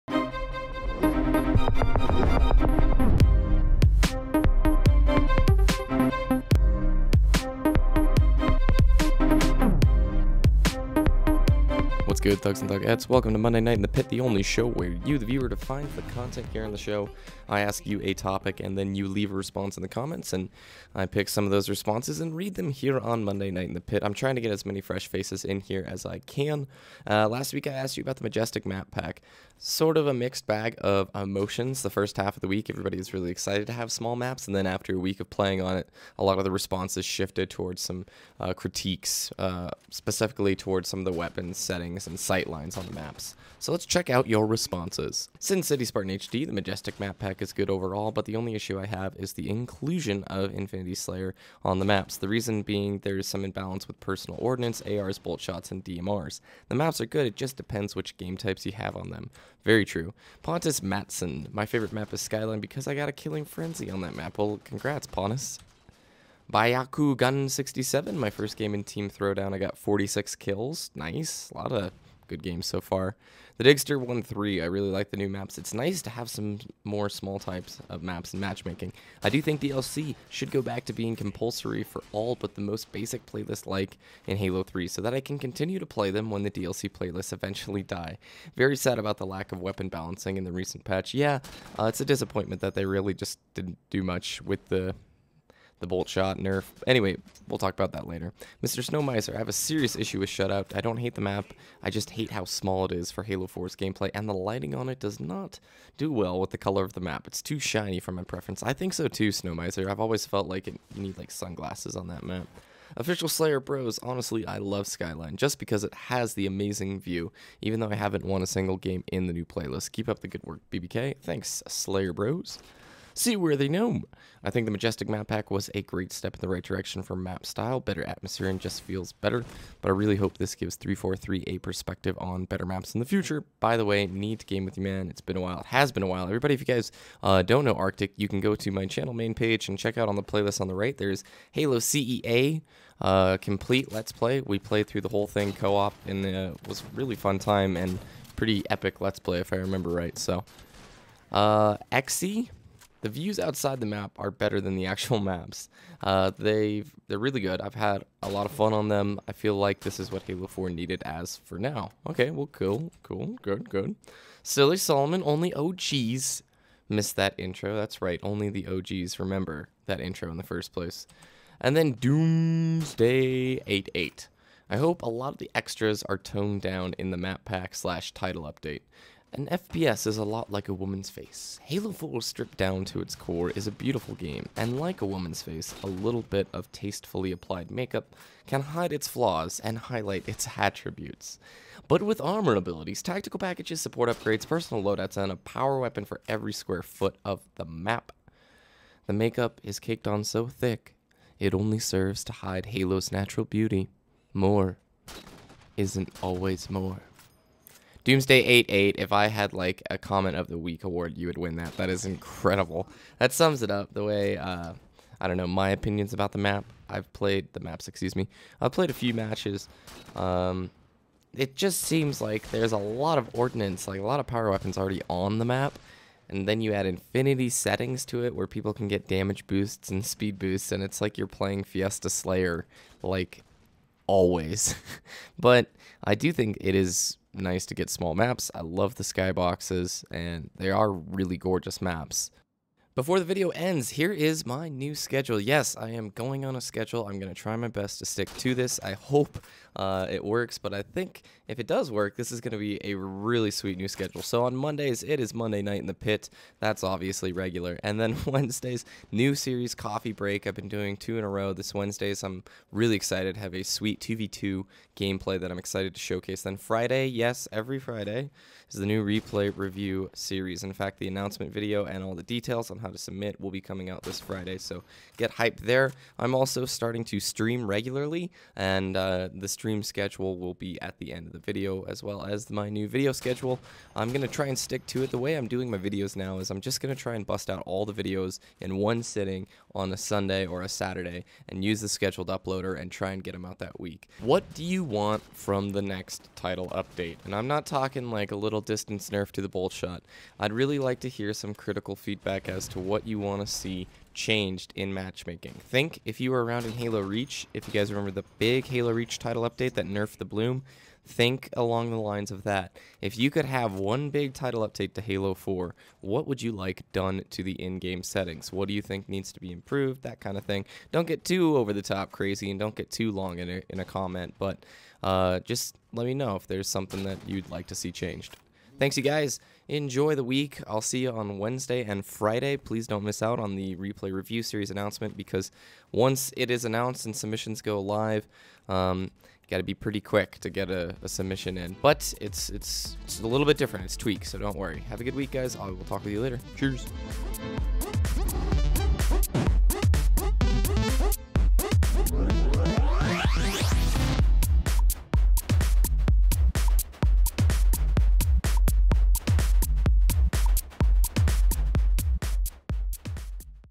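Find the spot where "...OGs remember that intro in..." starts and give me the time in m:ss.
2:48.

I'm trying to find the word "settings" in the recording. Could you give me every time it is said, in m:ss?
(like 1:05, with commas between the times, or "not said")
0:41, 3:47, 5:18.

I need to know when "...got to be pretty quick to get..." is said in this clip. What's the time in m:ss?
5:39.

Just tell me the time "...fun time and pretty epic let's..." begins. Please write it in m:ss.
2:27.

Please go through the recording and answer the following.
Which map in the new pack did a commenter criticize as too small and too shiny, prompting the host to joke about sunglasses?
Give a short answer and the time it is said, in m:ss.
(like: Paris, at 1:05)
Shutout, at 1:40.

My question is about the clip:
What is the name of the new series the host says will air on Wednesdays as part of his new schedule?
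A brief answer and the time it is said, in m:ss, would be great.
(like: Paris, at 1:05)
Coffee Break, at 4:19.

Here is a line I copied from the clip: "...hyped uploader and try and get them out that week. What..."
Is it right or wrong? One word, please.
wrong.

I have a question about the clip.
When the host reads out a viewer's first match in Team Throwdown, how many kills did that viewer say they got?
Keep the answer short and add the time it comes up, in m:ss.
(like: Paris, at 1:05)
46, at 1:09.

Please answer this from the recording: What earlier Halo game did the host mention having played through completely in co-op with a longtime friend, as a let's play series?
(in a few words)
Halo CEA.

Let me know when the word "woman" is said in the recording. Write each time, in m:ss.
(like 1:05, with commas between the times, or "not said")
3:00, 3:05.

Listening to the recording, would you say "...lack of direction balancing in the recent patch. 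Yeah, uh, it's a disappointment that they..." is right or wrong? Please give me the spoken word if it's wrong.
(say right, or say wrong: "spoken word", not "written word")
wrong: "weapon", not "direction".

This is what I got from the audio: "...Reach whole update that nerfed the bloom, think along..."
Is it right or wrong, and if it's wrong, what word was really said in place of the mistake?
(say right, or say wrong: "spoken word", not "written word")
wrong: "title", not "whole".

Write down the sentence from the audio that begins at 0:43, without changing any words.
So let's check out your responses.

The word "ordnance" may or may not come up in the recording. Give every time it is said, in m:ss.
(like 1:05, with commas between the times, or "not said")
0:54, 3:43.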